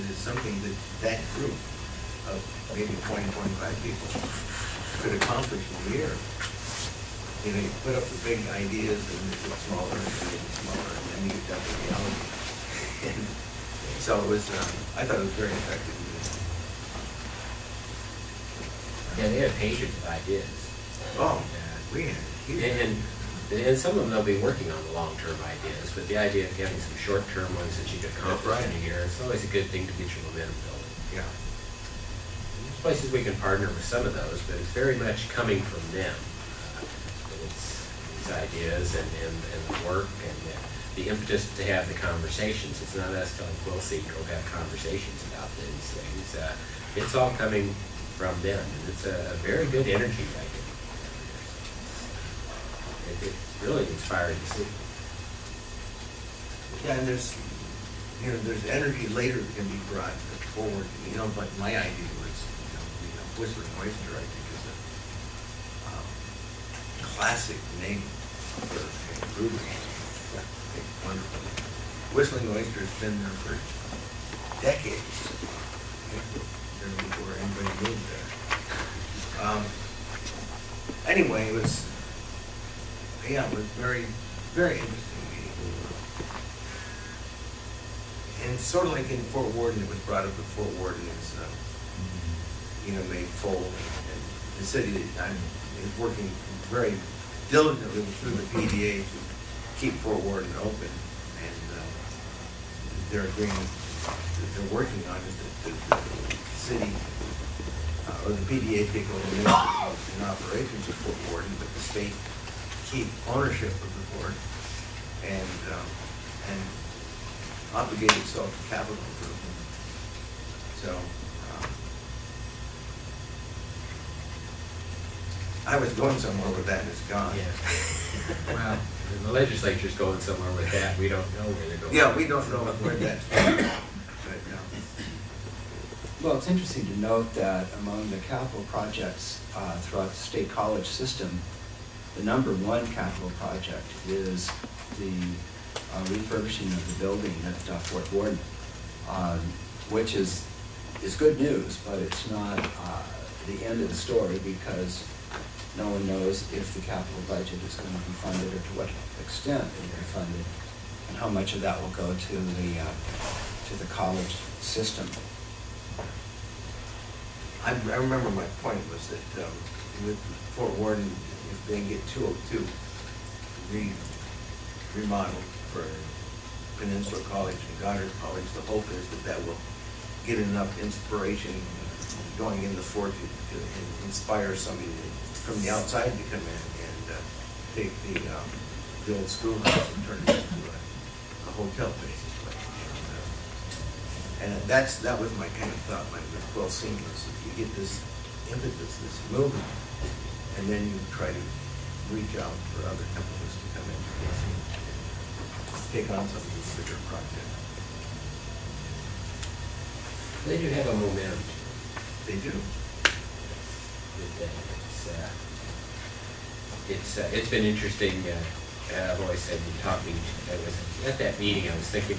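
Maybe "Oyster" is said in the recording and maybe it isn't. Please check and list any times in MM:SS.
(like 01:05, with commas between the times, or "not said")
01:03, 01:12.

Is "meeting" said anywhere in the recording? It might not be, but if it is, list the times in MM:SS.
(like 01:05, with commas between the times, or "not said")
01:25, 03:41.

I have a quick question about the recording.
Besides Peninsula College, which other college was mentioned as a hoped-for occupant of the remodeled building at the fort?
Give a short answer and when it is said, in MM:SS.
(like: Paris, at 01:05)
Goddard College, at 02:57.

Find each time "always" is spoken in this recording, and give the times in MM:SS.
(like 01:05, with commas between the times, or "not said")
00:29, 03:39.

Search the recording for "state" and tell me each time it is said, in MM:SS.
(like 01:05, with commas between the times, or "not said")
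01:51, 02:20.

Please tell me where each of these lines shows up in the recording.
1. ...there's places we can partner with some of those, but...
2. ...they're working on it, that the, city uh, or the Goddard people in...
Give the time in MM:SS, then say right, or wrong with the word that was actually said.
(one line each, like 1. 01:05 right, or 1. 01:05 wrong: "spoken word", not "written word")
1. 00:32 right
2. 01:44 wrong: "PDA", not "Goddard".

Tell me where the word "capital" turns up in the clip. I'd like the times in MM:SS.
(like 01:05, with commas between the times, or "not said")
01:58, 02:18, 02:22, 02:36.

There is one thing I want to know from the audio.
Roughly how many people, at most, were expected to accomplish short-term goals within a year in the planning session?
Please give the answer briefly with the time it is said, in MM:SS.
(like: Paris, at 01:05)
25, at 00:03.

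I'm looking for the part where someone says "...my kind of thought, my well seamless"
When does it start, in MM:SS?
03:15.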